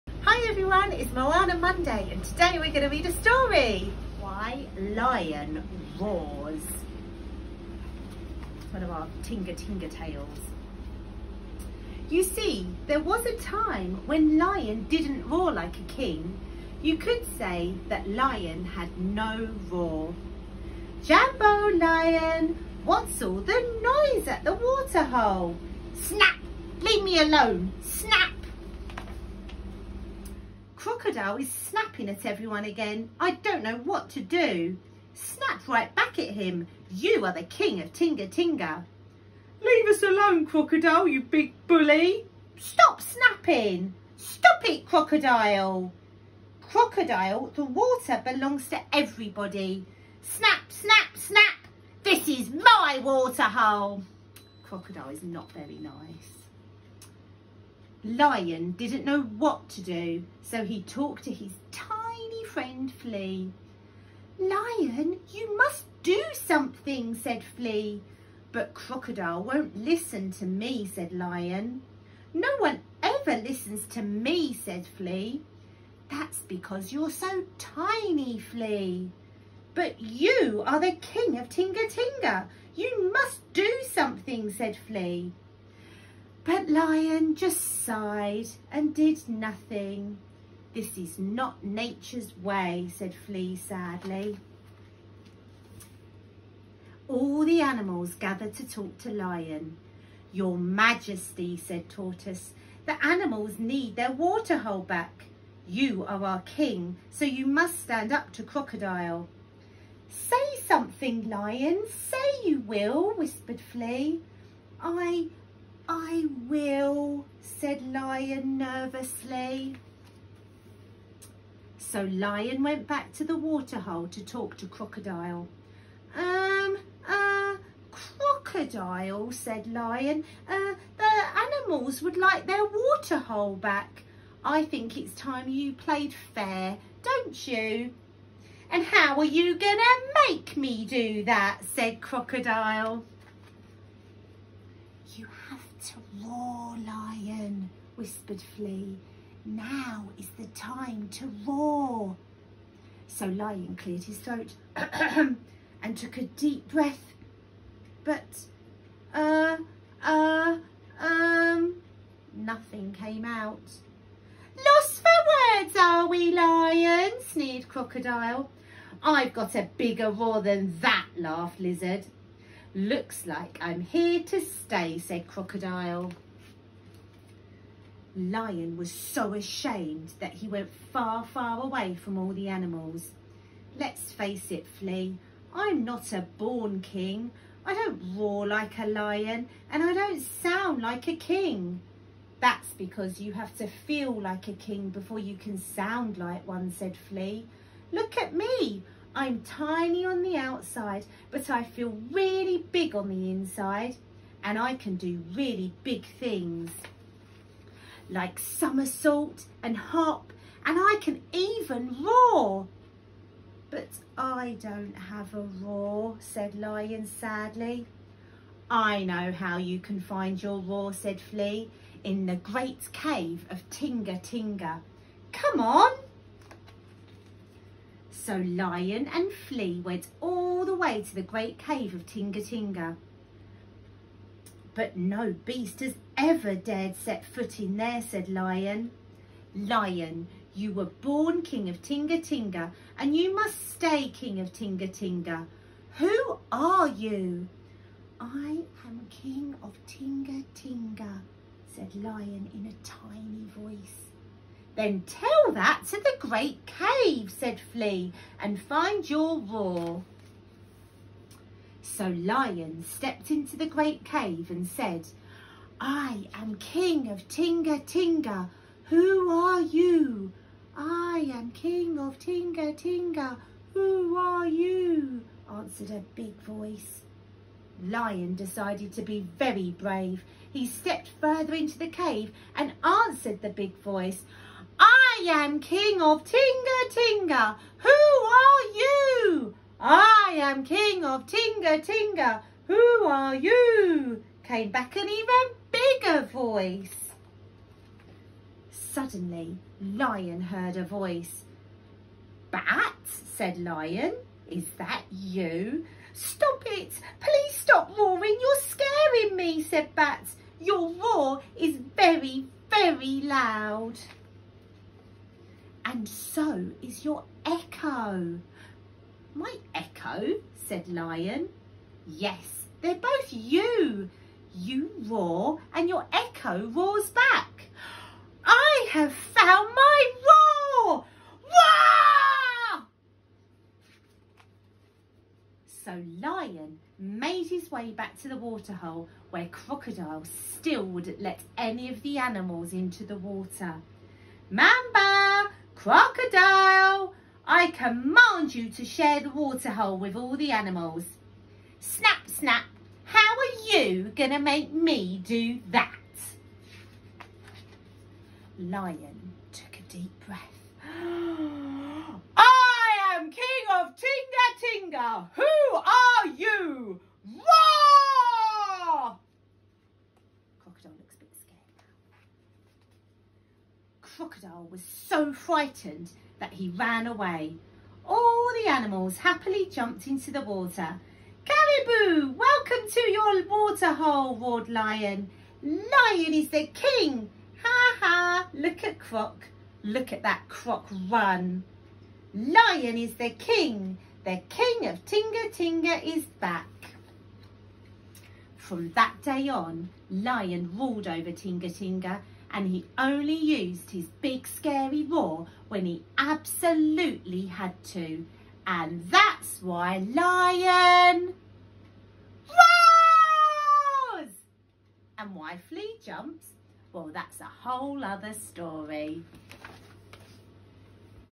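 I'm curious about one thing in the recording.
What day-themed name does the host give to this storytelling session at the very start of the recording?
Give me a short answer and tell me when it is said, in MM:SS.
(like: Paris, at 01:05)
Moana Monday, at 00:01.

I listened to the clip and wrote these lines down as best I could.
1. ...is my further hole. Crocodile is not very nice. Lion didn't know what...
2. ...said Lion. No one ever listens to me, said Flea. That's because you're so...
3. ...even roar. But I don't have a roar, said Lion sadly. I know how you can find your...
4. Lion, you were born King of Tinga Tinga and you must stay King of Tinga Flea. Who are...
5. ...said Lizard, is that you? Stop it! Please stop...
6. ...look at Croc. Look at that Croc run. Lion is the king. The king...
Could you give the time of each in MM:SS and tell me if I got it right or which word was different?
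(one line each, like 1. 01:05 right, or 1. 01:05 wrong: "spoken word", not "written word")
1. 00:52 wrong: "water", not "further"
2. 01:10 right
3. 03:31 right
4. 03:59 wrong: "Tinga", not "Flea"
5. 05:03 wrong: "Lion", not "Lizard"
6. 06:28 right.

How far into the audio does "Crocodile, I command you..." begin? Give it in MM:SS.
05:45.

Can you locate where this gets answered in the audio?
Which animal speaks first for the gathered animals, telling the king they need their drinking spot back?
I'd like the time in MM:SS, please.
01:41.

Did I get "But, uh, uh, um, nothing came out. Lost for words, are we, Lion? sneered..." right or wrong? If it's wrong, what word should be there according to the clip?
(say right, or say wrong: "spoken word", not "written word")
right.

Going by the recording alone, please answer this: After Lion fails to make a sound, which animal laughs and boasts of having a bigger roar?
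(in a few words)
Lizard.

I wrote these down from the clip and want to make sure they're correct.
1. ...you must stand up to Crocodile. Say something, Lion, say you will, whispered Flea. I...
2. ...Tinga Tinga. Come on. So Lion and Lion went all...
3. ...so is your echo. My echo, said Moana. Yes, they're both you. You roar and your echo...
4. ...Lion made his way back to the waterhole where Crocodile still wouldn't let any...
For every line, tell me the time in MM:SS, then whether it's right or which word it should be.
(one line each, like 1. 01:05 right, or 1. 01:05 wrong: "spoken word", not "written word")
1. 01:47 right
2. 03:43 wrong: "Flea", not "Lion"
3. 05:16 wrong: "Lion", not "Moana"
4. 05:36 right.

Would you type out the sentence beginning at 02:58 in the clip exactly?
Lion was so ashamed that he went far, far away from all the animals.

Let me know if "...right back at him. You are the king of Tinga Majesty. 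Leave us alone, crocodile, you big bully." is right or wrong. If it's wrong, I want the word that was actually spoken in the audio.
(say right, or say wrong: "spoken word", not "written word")
wrong: "Tinga", not "Majesty".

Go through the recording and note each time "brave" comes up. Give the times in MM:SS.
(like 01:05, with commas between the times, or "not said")
04:39.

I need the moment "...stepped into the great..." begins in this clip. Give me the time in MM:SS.
04:22.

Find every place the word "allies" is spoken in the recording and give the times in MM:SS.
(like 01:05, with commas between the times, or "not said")
not said.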